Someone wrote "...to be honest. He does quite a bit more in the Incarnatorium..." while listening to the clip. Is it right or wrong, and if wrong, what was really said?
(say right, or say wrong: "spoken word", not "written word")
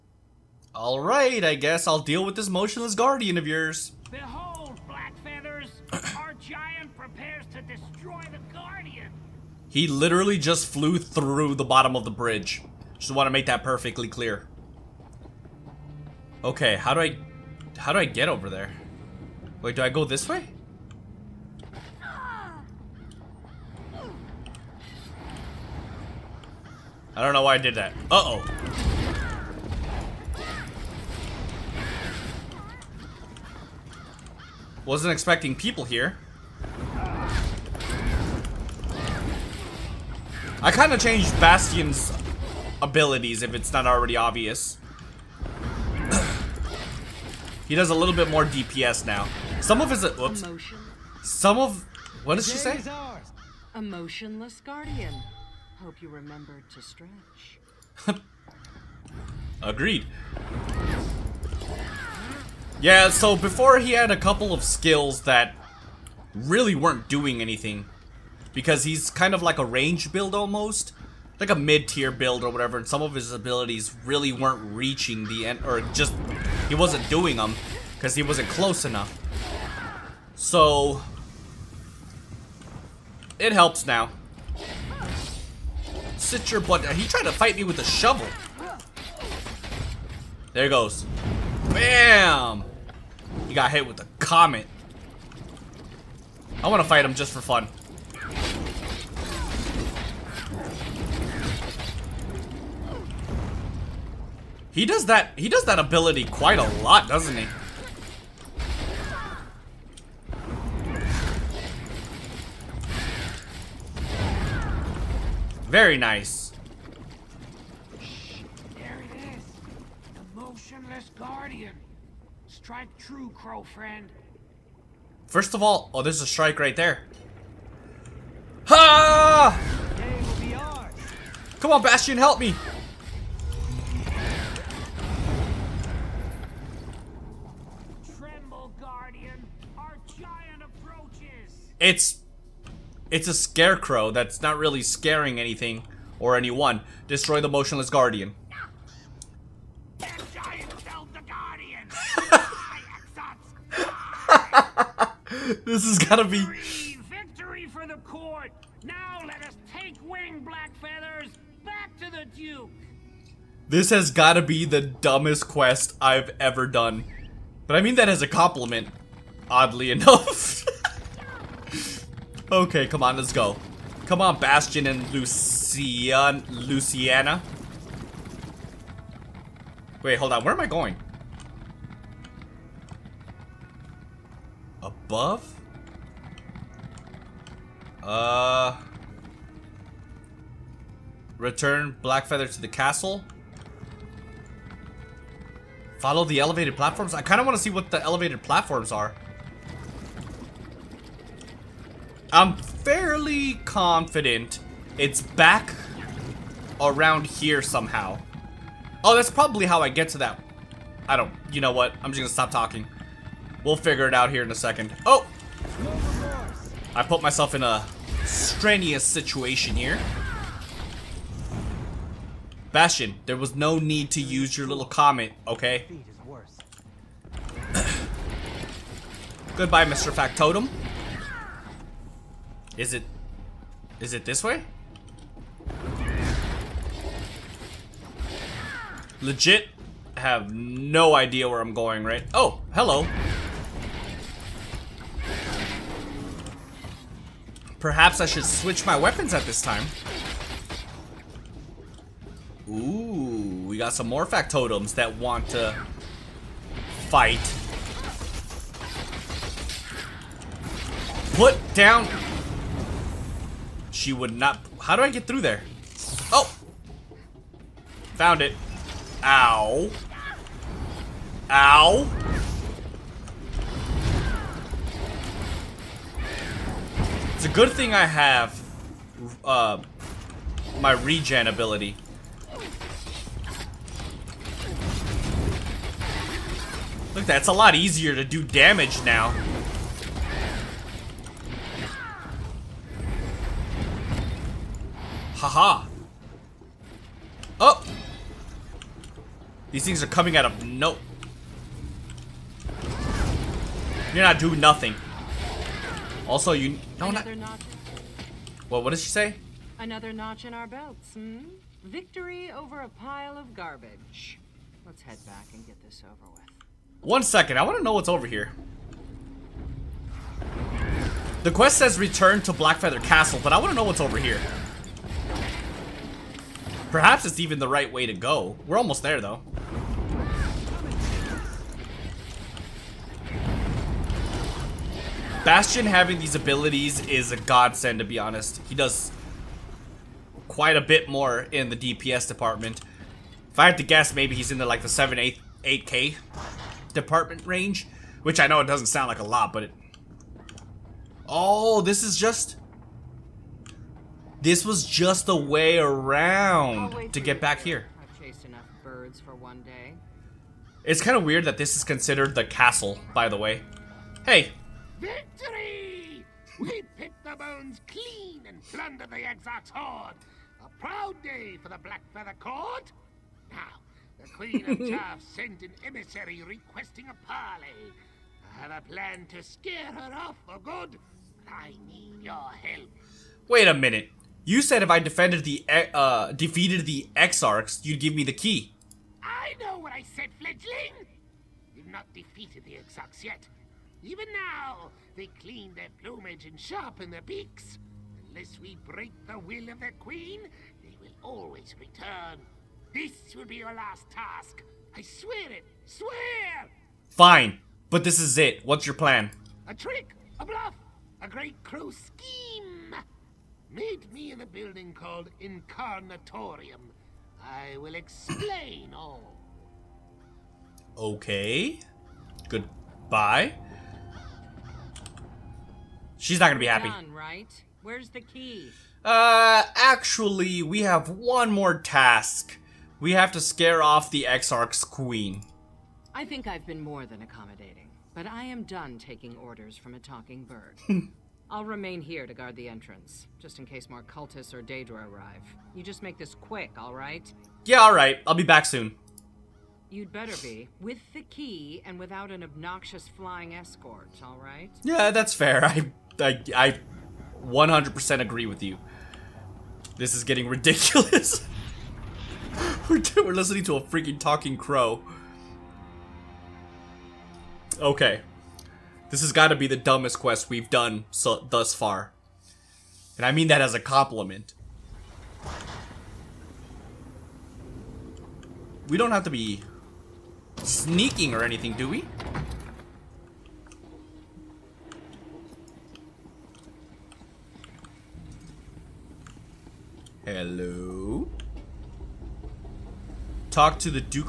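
wrong: "DPS", not "Incarnatorium".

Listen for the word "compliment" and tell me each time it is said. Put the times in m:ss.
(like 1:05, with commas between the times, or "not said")
2:48, 7:53.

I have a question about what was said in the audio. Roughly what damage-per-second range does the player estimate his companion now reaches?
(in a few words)
7-8k.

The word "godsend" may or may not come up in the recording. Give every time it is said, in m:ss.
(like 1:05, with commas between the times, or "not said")
5:37.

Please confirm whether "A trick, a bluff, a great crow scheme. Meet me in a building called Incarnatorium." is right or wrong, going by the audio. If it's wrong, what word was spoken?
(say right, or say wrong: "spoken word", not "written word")
right.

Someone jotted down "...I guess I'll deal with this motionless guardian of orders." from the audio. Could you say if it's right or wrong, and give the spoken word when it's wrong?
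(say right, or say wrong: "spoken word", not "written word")
wrong: "yours", not "orders".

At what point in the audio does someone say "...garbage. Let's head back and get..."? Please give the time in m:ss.
5:13.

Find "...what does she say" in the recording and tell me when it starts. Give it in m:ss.
0:52.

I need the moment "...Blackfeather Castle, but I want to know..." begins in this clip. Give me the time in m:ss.
5:22.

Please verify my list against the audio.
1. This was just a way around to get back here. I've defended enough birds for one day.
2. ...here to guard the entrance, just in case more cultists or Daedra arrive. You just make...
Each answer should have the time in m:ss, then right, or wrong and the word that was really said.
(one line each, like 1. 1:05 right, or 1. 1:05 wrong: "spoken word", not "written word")
1. 5:54 wrong: "chased", not "defended"
2. 7:22 right.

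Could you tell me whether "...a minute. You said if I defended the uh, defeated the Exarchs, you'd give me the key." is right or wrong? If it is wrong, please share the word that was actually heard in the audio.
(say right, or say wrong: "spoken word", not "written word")
right.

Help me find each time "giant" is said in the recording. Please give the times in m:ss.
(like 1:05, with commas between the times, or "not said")
0:06, 2:20.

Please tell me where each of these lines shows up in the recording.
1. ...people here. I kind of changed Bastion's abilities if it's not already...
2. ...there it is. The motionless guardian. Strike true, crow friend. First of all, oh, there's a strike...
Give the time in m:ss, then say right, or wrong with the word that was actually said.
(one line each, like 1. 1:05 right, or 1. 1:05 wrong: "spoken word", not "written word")
1. 0:35 right
2. 1:58 right.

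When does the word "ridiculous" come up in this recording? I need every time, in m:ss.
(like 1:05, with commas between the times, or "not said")
7:40.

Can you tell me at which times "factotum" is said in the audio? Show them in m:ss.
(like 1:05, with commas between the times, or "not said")
3:50, 4:14.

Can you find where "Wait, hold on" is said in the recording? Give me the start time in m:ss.
3:00.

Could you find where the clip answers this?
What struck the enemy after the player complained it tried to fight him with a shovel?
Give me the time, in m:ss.
1:34.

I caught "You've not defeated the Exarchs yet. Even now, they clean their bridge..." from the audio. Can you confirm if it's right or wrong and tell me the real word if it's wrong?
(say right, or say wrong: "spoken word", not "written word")
wrong: "plumage", not "bridge".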